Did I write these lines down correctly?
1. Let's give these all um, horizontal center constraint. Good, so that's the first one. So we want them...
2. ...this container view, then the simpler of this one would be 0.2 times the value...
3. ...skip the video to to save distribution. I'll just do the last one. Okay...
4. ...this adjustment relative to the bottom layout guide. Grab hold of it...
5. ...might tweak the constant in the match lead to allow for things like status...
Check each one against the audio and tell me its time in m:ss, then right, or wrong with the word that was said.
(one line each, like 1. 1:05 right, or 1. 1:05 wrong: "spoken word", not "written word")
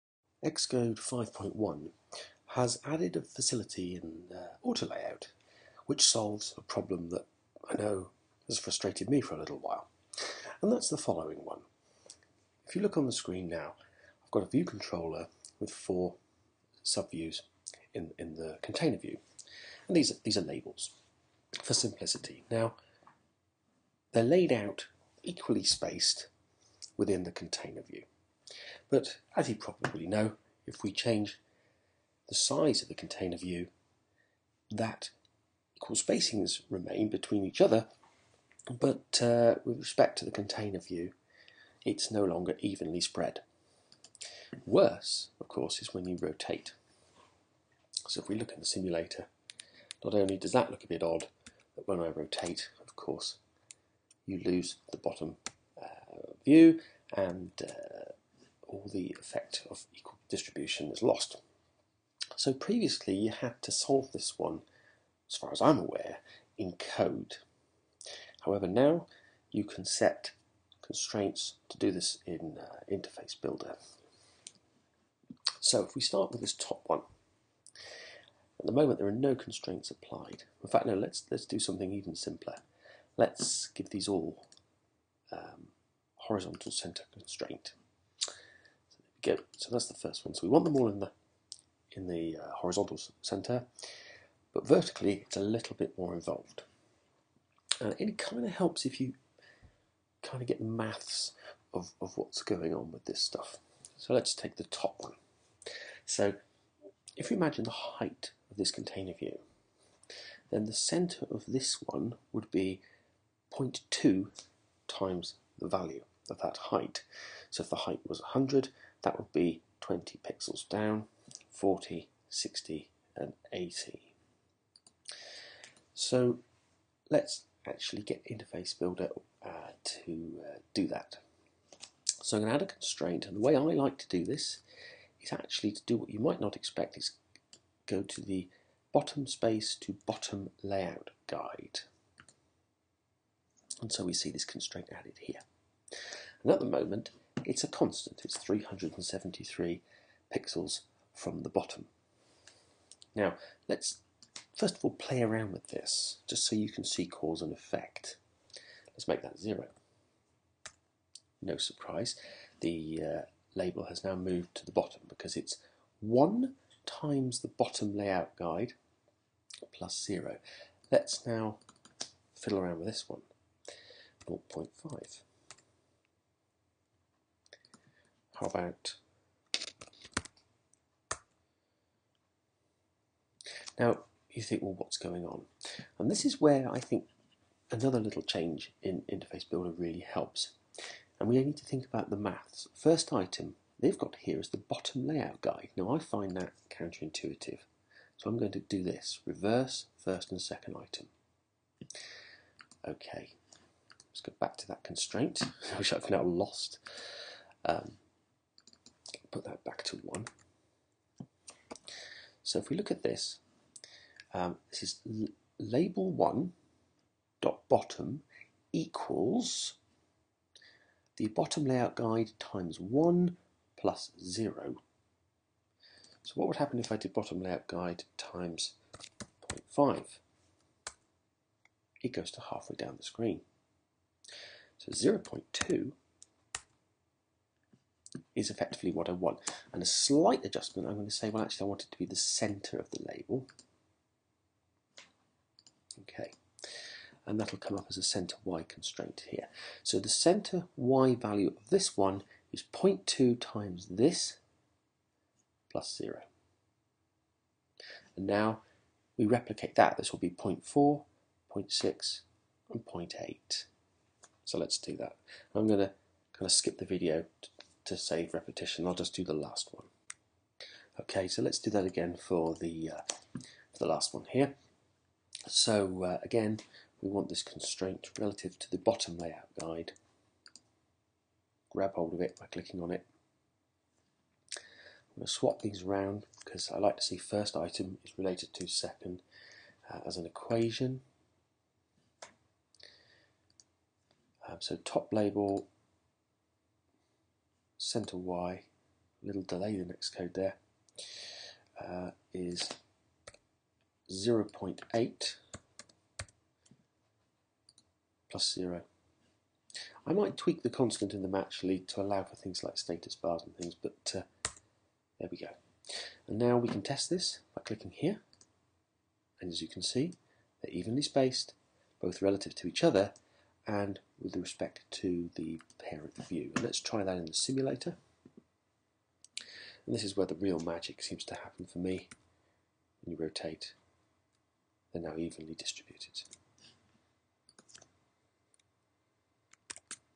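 1. 1:23 right
2. 1:48 wrong: "center", not "simpler"
3. 4:26 wrong: "repetition", not "distribution"
4. 4:37 wrong: "constraint", not "adjustment"
5. 5:10 right.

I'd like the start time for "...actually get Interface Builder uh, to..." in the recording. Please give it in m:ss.
2:07.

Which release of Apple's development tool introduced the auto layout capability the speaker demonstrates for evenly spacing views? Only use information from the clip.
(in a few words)
Xcode 5.1.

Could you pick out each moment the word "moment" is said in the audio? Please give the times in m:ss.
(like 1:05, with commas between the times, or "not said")
1:18, 2:26.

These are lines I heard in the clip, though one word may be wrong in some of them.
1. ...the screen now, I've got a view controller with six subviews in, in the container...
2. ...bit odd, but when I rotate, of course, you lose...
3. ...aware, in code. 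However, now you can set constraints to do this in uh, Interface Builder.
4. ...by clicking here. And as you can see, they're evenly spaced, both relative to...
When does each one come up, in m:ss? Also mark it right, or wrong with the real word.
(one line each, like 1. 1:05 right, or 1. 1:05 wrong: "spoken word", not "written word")
1. 0:13 wrong: "four", not "six"
2. 0:50 right
3. 1:05 right
4. 5:17 right.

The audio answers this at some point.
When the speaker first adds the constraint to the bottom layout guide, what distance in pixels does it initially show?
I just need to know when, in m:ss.
2:28.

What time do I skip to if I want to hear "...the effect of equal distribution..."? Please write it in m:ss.
0:58.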